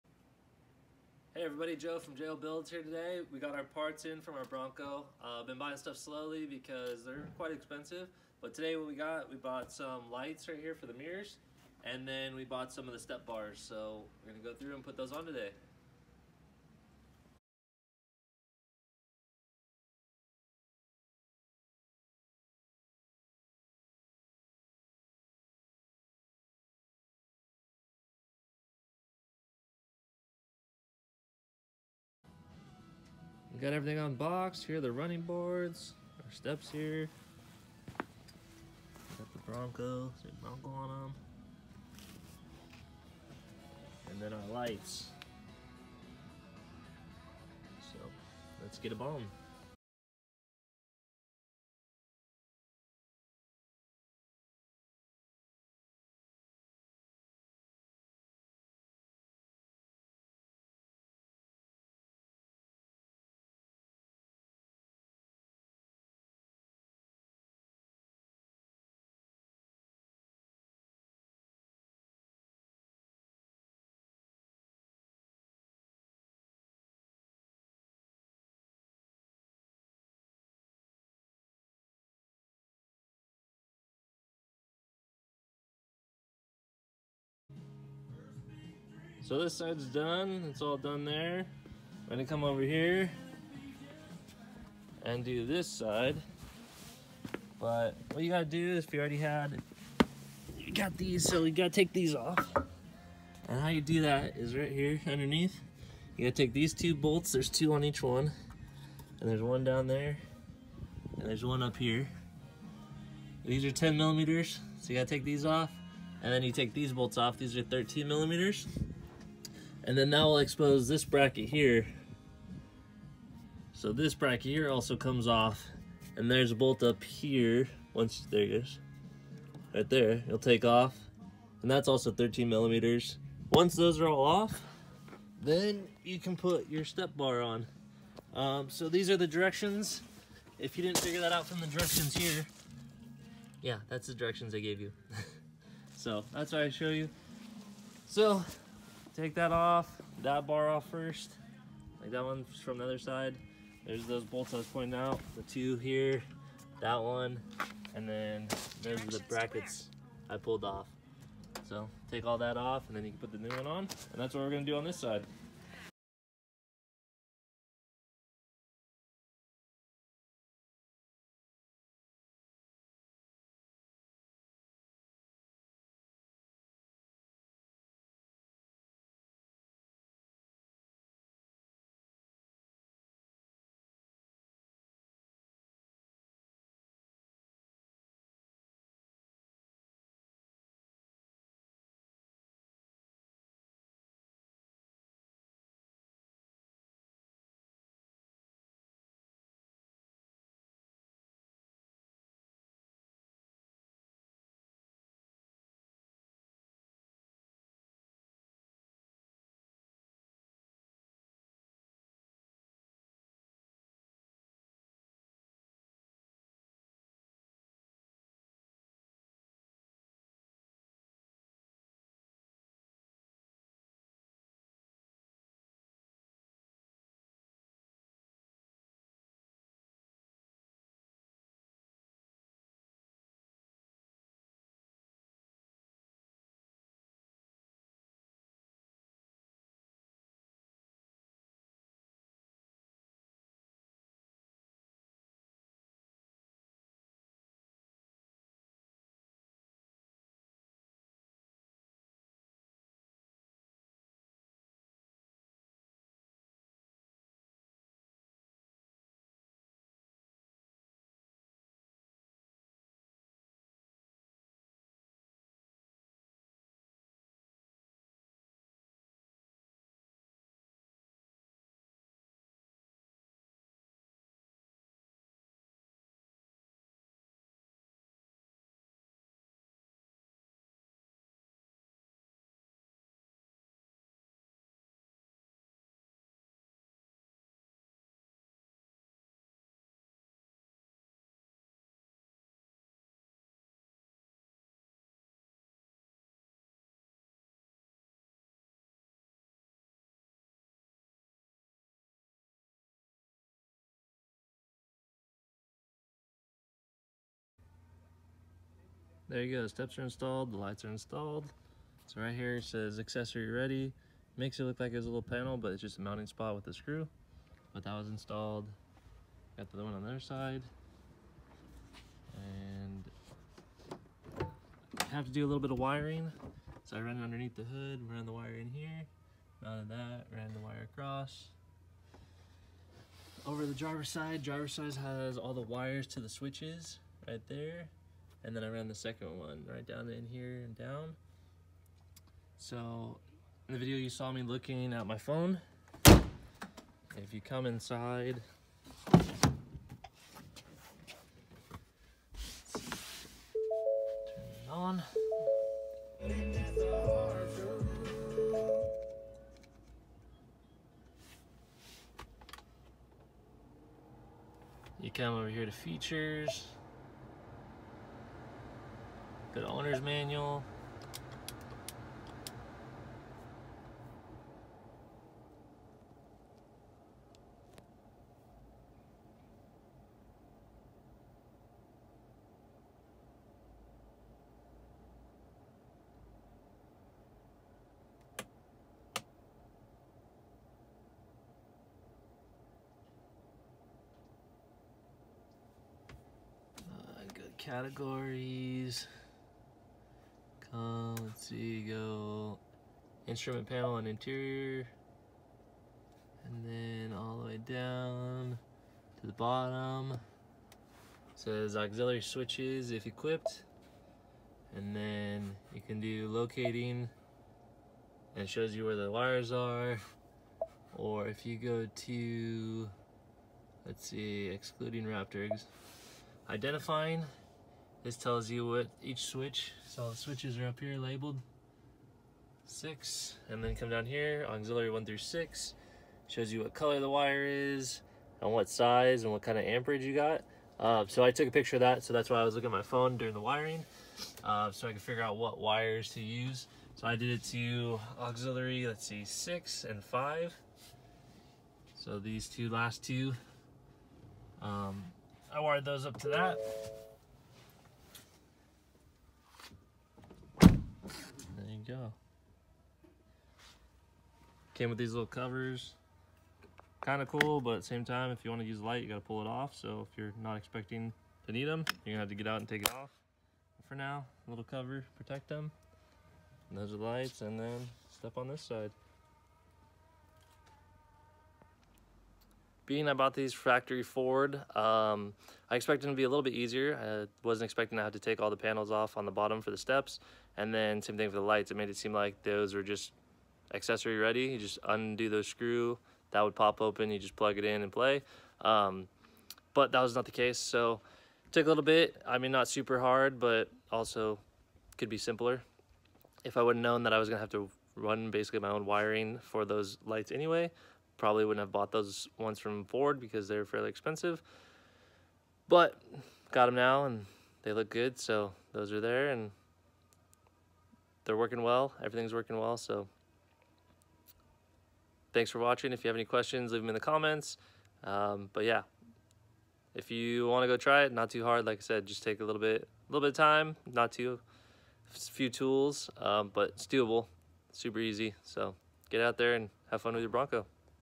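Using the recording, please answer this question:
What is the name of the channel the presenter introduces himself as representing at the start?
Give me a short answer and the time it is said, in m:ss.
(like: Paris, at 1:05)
JO Builds, at 0:02.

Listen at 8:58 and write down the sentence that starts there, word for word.
So get out there and have fun with your Bronco.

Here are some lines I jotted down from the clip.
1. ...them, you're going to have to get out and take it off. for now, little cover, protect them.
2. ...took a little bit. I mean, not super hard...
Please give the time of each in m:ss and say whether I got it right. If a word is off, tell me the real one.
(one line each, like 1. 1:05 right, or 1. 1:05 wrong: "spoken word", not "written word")
1. 7:51 right
2. 8:21 right.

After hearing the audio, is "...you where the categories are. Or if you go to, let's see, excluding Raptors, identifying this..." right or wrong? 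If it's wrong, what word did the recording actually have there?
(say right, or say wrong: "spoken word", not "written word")
wrong: "wires", not "categories".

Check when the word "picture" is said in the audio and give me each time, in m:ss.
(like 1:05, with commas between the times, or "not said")
7:21.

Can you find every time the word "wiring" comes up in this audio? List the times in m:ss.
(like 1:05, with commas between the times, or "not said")
5:25, 7:23, 8:28.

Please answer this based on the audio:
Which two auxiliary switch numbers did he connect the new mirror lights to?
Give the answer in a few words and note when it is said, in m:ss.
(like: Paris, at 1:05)
6 and 5, at 7:29.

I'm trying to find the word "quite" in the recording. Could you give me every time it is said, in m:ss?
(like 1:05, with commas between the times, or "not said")
0:07.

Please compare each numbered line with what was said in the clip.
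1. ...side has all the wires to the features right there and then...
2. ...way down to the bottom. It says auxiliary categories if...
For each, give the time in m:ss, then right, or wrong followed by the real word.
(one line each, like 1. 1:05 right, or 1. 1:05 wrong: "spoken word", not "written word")
1. 5:34 wrong: "switches", not "features"
2. 6:47 wrong: "switches", not "categories".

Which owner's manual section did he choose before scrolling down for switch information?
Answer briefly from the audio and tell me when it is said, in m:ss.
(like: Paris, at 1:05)
Instrument panel and interior, at 6:43.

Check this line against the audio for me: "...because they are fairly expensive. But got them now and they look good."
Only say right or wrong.
right.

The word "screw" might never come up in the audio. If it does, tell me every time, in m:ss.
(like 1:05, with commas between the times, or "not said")
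5:16, 8:15.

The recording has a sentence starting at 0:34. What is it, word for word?
Here are the running boards, our steps here.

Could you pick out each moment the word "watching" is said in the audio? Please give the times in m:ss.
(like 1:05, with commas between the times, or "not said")
8:45.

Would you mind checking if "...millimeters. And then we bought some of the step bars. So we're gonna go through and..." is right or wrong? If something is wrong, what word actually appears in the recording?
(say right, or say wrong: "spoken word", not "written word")
wrong: "mirrors", not "millimeters".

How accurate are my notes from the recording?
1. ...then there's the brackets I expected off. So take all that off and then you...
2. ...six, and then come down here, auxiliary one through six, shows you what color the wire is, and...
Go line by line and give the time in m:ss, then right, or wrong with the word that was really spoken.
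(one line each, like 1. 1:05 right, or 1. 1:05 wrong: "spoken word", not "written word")
1. 2:38 wrong: "pulled", not "expected"
2. 7:12 right.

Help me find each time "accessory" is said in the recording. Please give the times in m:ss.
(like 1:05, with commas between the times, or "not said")
5:12, 8:13.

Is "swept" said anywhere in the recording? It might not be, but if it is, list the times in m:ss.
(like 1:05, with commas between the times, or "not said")
not said.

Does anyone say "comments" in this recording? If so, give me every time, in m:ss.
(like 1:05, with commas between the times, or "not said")
8:46.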